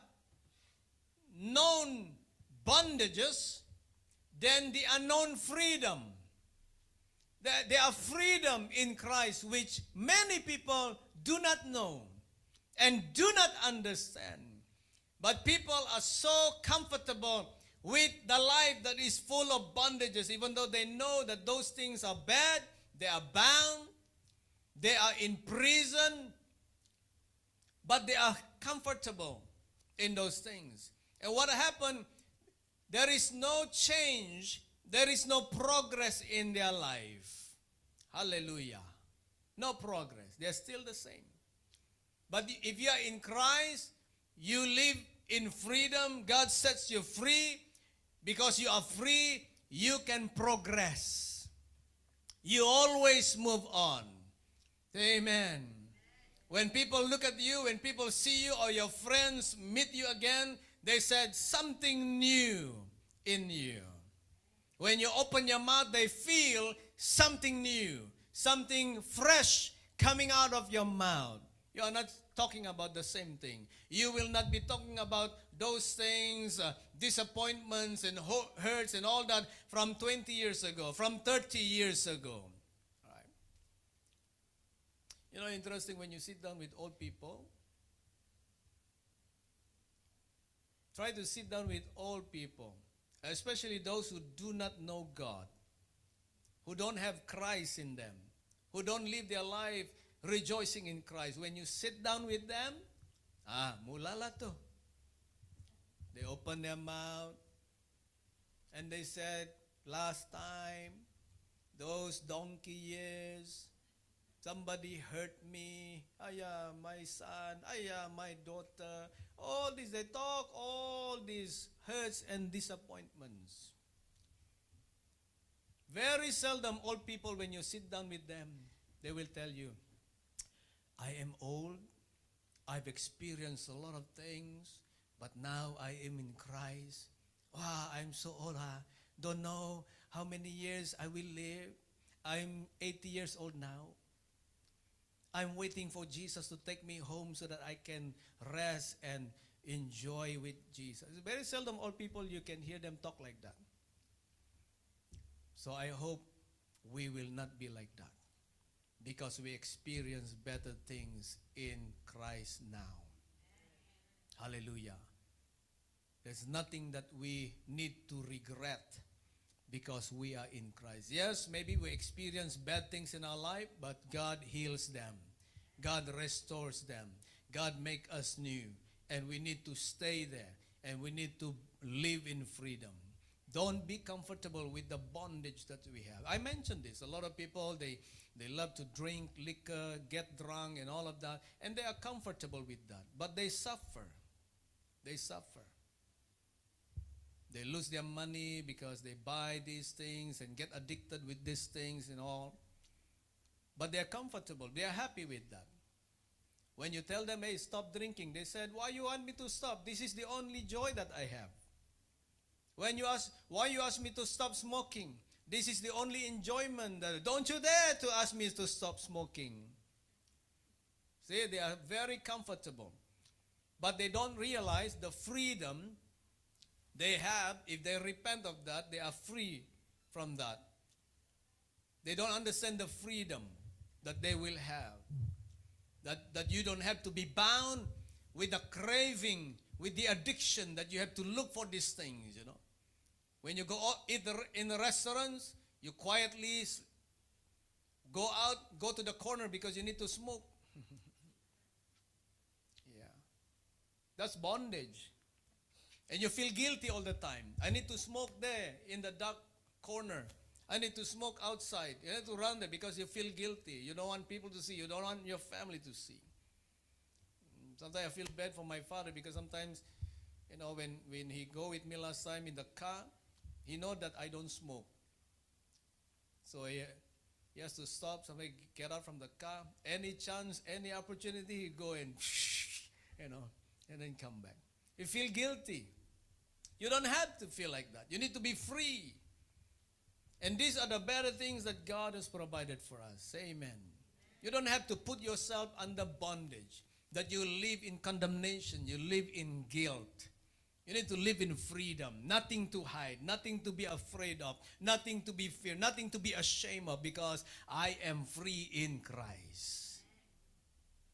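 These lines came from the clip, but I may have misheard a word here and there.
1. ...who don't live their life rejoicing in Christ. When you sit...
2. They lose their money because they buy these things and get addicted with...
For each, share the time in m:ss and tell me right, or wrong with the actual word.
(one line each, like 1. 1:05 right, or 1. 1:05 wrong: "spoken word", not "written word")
1. 1:38 right
2. 3:17 right.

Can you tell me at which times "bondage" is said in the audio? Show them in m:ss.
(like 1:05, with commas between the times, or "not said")
0:02, 0:19, 3:04, 4:14, 4:56.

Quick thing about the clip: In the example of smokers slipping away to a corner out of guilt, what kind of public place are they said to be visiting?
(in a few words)
restaurants.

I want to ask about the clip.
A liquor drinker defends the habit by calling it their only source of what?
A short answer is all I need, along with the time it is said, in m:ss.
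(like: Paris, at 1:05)
joy, at 3:30.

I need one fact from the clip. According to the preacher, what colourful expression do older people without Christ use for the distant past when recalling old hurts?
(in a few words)
donkey years.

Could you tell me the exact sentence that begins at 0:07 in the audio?
There are freedom in Christ which many people do not know and do not understand.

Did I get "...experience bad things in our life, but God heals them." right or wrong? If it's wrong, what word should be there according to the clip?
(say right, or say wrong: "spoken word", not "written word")
right.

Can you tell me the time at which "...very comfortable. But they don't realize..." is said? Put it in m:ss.
3:41.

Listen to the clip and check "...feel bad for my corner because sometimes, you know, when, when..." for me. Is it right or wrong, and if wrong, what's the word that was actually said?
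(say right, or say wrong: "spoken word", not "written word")
wrong: "father", not "corner".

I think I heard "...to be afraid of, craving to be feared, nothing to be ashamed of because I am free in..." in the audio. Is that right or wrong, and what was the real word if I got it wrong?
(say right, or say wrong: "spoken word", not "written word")
wrong: "nothing", not "craving".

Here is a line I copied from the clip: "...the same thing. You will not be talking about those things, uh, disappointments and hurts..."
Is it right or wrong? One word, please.
right.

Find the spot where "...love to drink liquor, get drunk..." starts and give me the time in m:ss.
3:08.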